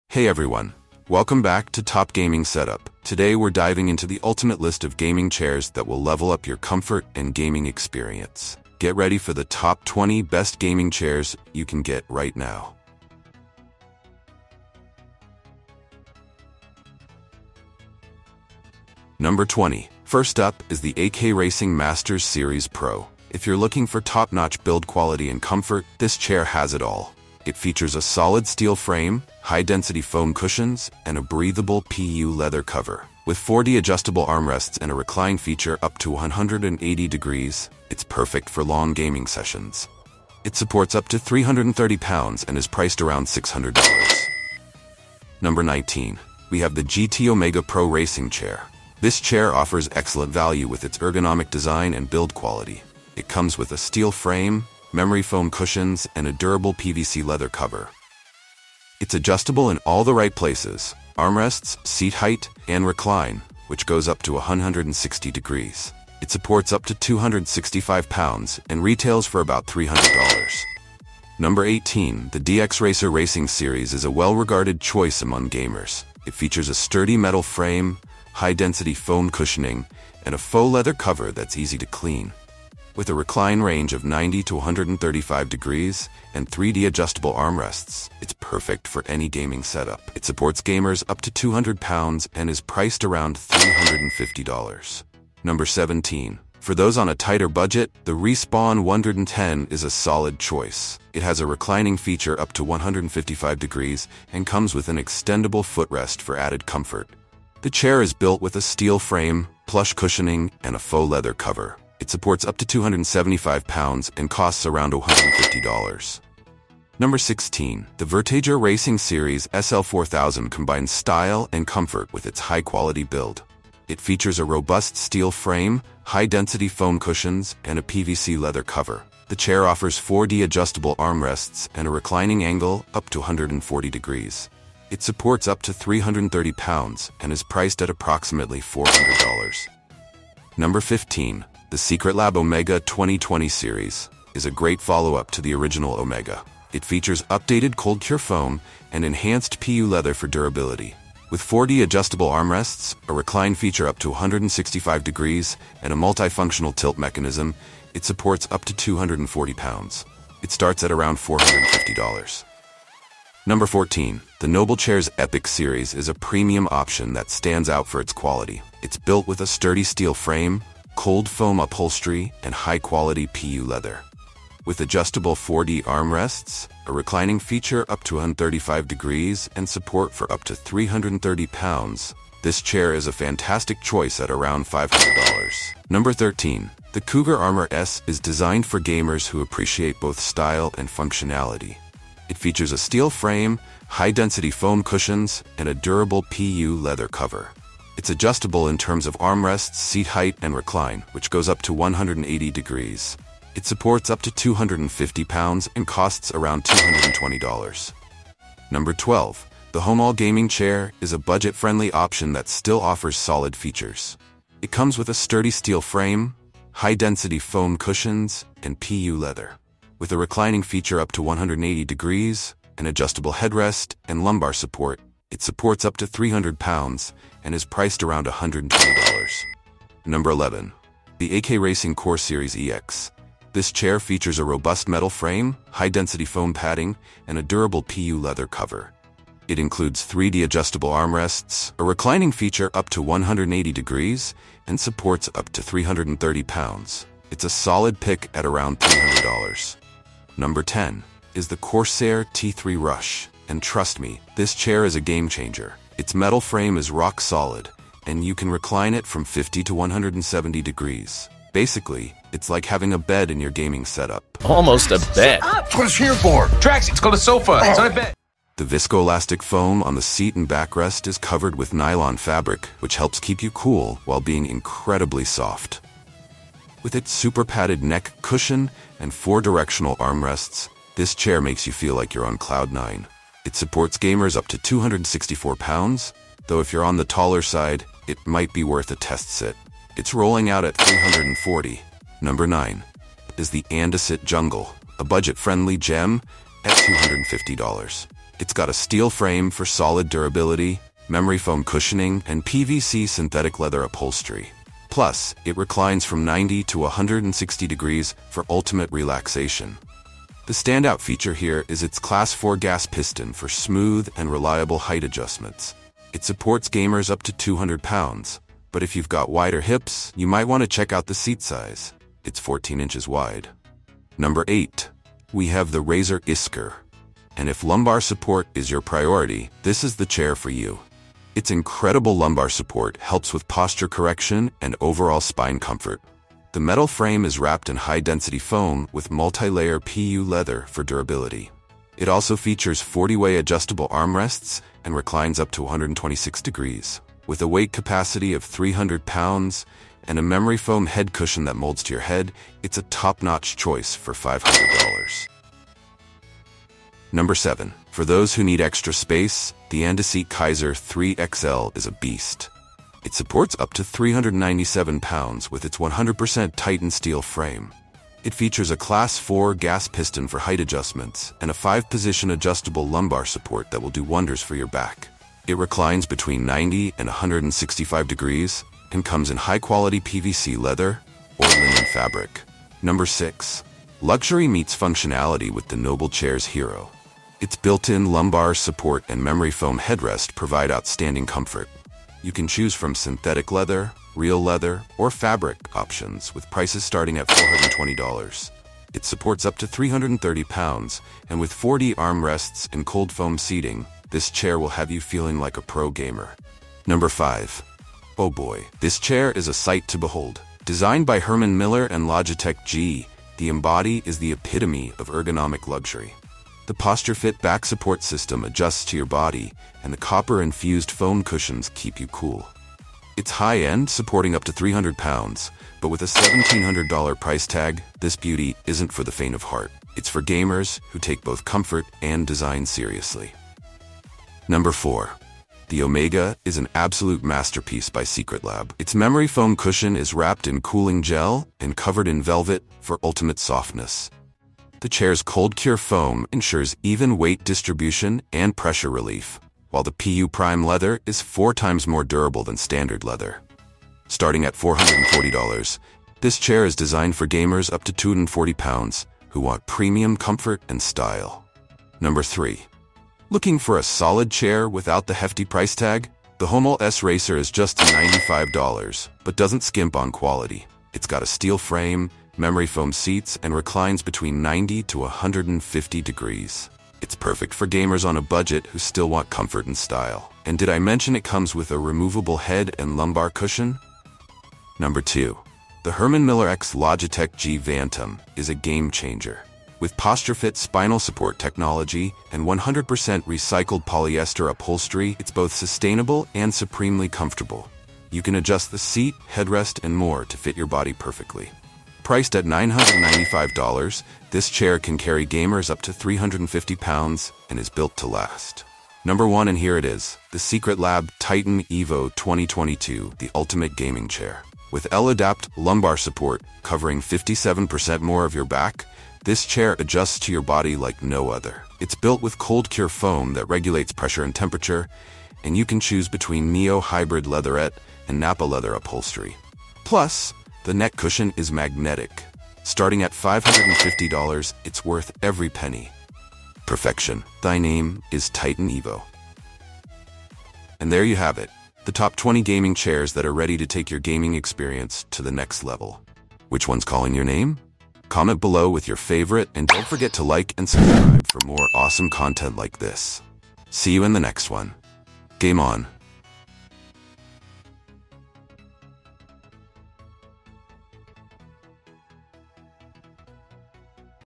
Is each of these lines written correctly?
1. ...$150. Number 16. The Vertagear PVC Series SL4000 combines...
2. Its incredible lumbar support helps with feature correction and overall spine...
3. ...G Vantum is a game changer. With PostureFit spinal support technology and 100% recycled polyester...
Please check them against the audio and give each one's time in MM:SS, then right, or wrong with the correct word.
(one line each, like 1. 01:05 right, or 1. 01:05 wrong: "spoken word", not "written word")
1. 01:54 wrong: "Racing", not "PVC"
2. 05:31 wrong: "posture", not "feature"
3. 08:07 right.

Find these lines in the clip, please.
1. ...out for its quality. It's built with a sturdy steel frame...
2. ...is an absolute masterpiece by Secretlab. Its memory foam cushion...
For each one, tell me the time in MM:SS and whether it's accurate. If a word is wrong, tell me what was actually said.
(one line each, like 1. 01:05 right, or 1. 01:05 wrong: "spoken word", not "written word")
1. 02:47 right
2. 07:16 right.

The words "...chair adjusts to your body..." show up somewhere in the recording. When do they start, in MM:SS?
08:39.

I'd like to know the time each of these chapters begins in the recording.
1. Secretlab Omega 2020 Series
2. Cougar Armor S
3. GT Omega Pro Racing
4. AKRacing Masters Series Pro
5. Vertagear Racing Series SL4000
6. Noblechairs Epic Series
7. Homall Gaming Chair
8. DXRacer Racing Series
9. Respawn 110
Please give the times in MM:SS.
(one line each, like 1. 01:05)
1. 02:20
2. 03:05
3. 00:45
4. 00:18
5. 01:56
6. 02:42
7. 03:28
8. 01:11
9. 01:35.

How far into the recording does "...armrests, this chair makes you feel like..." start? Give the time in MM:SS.
04:39.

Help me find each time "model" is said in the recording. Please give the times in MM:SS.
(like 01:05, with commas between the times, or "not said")
not said.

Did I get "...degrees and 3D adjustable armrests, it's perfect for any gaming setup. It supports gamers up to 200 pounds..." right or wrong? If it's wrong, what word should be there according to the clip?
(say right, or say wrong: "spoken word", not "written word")
right.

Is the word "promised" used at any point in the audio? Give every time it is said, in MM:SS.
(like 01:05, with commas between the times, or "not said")
not said.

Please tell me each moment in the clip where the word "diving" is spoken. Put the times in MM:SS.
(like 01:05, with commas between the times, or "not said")
00:03.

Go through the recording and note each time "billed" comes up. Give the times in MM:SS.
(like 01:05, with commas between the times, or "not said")
not said.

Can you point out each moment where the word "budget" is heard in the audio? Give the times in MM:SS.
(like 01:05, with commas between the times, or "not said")
01:37, 03:31, 04:55, 07:58.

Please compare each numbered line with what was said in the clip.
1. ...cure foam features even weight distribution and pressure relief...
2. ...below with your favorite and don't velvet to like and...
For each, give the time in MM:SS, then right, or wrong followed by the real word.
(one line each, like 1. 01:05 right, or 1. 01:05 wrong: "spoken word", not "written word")
1. 07:25 wrong: "ensures", not "features"
2. 09:08 wrong: "forget", not "velvet".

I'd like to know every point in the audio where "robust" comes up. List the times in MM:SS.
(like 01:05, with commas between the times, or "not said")
02:04, 03:54.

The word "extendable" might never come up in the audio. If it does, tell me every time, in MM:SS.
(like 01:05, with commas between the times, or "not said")
01:44.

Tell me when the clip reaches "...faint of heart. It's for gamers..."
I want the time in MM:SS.
07:09.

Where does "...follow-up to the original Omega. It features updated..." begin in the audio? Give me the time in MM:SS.
02:24.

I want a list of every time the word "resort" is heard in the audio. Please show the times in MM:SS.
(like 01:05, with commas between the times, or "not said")
not said.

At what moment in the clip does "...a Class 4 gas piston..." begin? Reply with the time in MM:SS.
06:08.